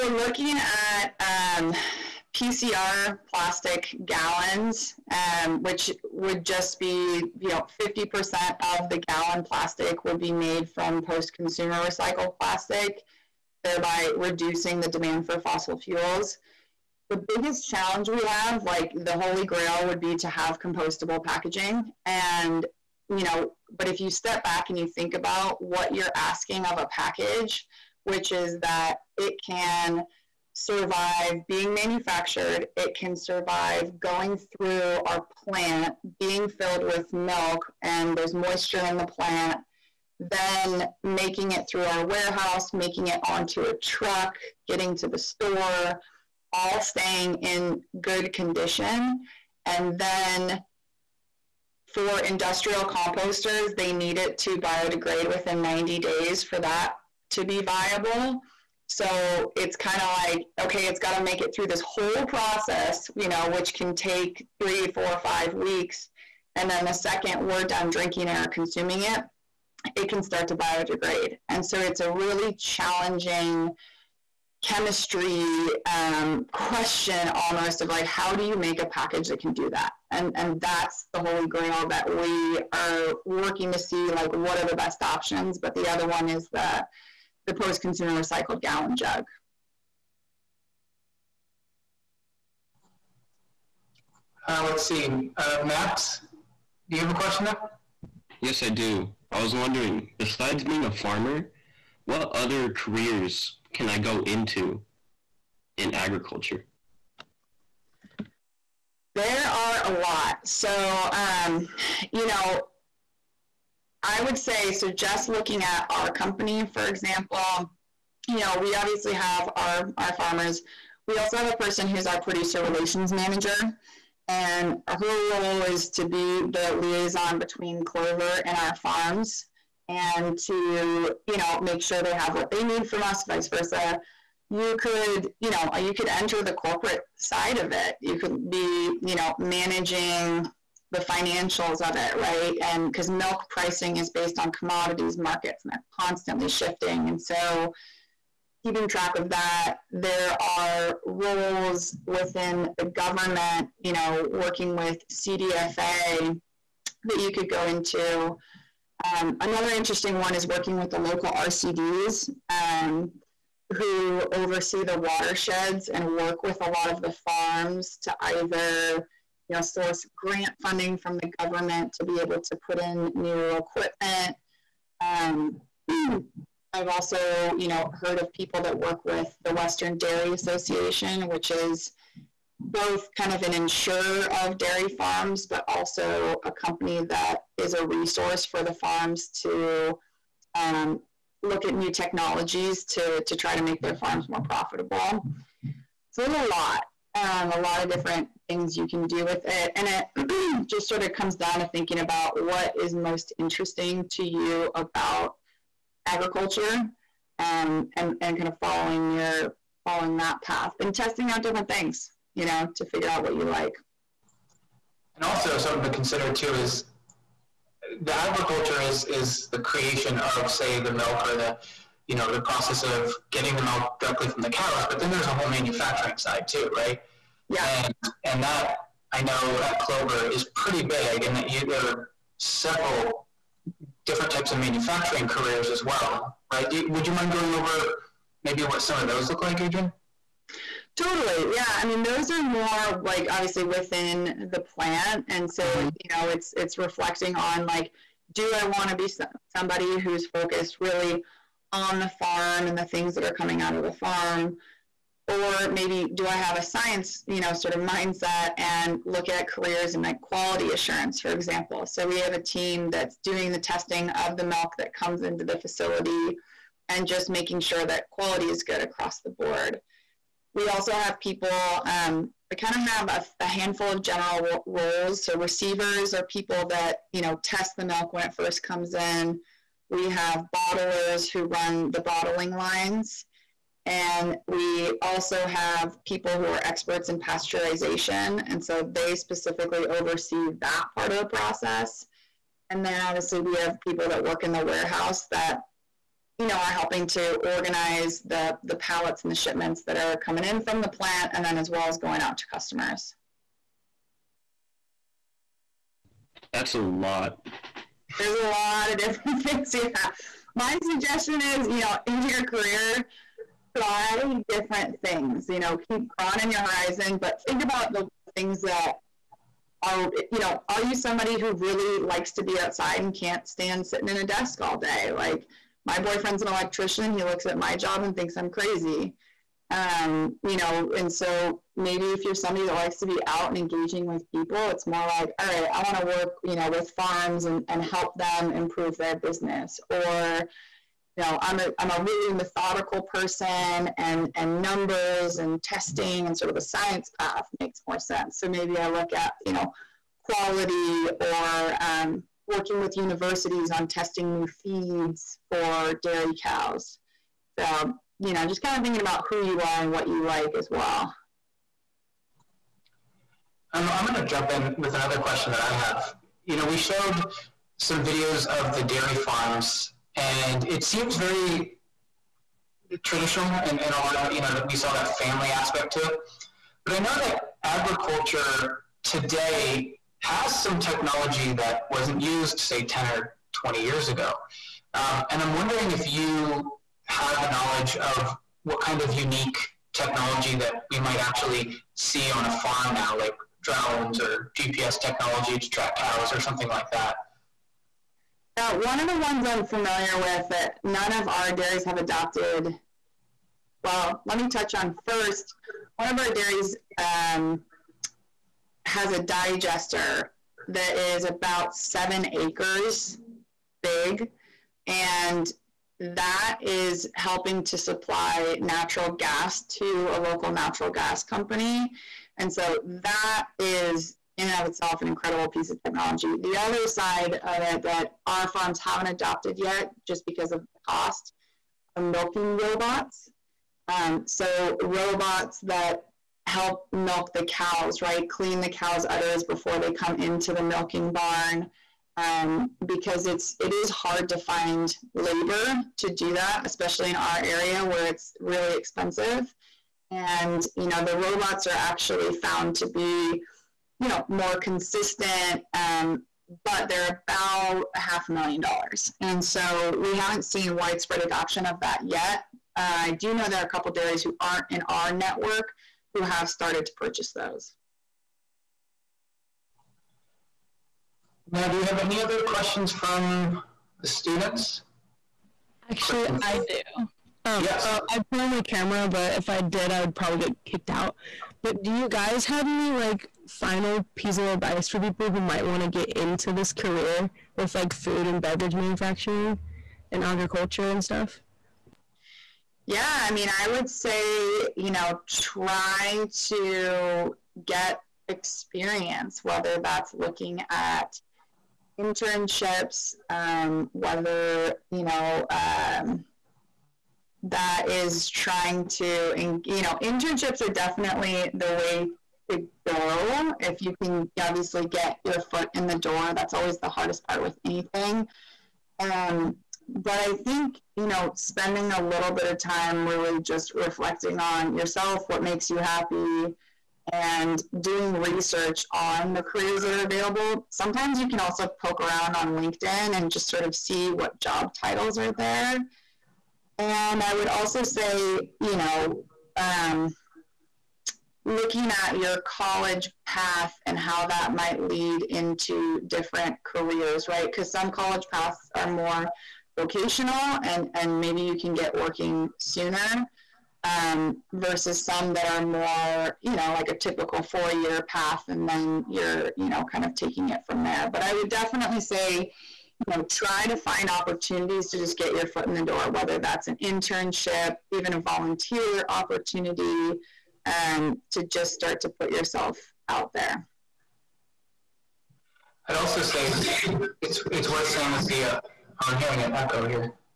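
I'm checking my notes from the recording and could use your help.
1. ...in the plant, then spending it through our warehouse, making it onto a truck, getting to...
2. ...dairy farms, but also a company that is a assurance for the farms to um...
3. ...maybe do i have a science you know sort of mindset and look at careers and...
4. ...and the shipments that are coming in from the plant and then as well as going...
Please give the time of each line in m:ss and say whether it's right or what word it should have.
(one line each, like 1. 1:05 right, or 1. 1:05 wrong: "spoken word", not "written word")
1. 0:38 wrong: "making", not "spending"
2. 3:04 wrong: "resource", not "assurance"
3. 4:15 right
4. 4:59 right.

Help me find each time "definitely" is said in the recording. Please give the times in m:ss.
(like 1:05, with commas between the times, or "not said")
8:30, 9:21.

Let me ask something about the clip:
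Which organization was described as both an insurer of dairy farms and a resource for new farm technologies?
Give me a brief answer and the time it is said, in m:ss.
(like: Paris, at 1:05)
Western Dairy Association, at 2:59.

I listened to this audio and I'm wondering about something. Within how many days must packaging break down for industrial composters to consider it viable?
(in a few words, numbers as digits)
90 days.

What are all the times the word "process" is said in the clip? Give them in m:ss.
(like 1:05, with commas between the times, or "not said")
1:02, 3:42, 4:51.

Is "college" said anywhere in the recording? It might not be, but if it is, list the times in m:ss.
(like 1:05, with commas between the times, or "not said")
9:02, 9:07.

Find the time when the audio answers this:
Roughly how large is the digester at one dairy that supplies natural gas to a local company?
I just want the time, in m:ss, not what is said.
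6:51.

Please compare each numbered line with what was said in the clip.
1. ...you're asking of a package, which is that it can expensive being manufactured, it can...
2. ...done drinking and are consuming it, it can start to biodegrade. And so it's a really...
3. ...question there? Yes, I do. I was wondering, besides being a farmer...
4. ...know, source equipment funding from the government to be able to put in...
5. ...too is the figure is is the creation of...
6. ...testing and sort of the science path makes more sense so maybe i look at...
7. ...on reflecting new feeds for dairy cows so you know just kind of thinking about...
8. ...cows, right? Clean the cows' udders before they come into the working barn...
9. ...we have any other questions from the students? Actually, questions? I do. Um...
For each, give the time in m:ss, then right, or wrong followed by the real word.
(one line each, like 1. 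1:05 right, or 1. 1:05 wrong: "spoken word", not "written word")
1. 0:25 wrong: "survive", not "expensive"
2. 1:07 right
3. 1:37 right
4. 2:49 wrong: "grant", not "equipment"
5. 3:36 wrong: "agriculture", not "figure"
6. 5:45 right
7. 5:53 wrong: "testing", not "reflecting"
8. 7:17 wrong: "milking", not "working"
9. 7:51 right.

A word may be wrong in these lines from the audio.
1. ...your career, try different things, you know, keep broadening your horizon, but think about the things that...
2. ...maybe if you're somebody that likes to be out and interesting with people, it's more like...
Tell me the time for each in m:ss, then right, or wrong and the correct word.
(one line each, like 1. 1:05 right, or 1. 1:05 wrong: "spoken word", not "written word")
1. 5:12 right
2. 5:31 wrong: "engaging", not "interesting".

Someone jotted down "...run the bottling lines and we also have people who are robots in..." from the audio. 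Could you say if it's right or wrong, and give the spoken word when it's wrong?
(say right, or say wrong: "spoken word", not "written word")
wrong: "experts", not "robots".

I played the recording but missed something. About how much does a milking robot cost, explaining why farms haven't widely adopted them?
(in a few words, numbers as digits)
half a million dollars.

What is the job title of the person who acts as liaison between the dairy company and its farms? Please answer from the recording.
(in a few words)
producer relations manager.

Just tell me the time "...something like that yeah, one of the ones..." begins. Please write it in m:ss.
6:36.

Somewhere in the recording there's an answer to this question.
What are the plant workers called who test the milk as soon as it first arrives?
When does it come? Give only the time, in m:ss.
4:35.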